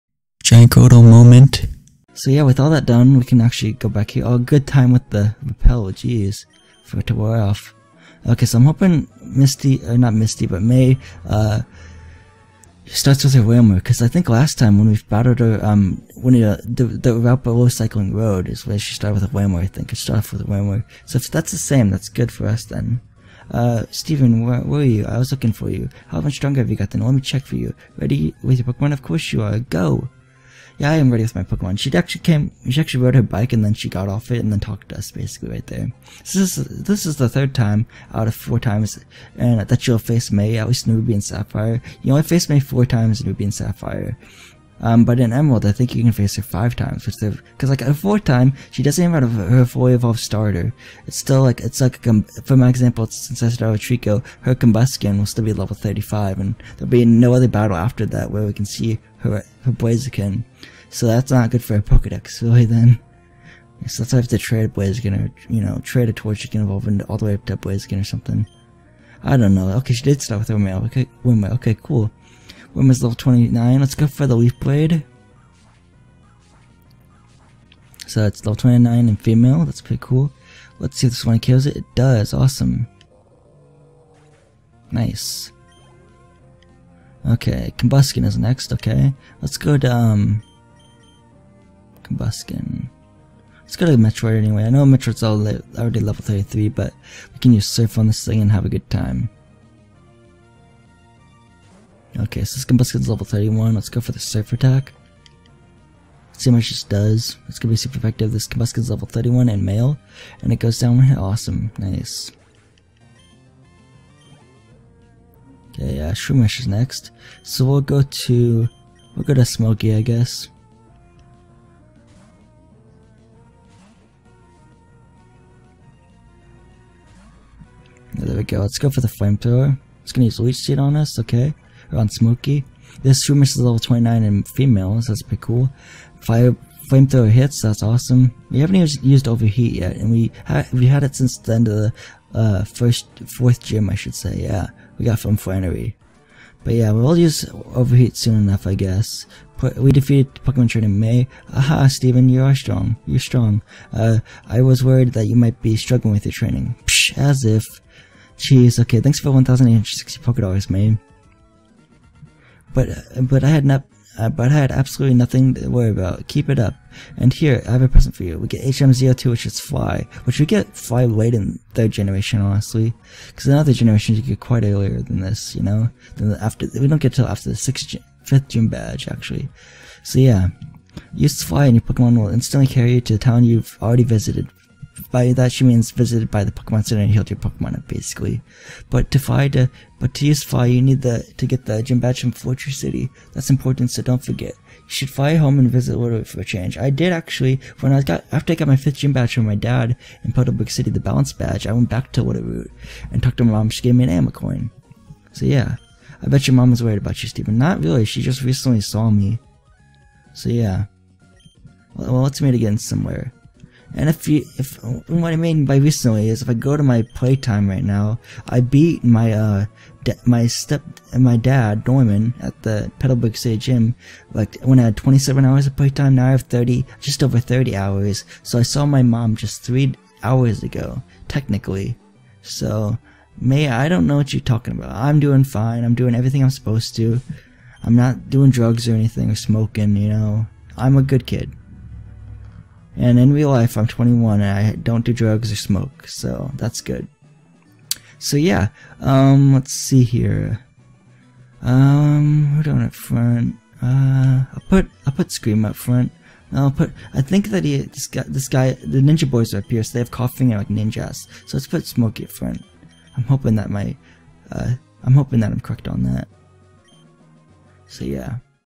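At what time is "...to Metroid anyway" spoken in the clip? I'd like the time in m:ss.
1:33.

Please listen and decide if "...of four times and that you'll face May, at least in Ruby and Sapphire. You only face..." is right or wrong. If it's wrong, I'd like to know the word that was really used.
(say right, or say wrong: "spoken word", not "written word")
right.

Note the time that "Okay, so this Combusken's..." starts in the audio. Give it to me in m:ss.
1:42.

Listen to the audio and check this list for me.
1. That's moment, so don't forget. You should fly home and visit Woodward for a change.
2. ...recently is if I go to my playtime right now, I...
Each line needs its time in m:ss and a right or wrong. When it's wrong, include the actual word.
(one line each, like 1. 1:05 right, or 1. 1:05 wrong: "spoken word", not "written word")
1. 3:13 wrong: "important", not "moment"
2. 3:35 right.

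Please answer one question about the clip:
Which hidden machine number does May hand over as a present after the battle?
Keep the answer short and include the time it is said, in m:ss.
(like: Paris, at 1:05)
HM 2, at 2:48.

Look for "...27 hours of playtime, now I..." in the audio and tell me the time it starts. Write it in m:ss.
3:44.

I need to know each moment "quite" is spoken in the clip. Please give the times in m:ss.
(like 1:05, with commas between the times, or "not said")
2:54.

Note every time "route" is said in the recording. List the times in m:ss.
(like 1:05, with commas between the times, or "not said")
0:17, 3:22.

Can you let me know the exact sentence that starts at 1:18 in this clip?
So it's level 29 and female.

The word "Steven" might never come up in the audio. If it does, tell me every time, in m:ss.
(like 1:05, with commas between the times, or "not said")
0:23, 2:31.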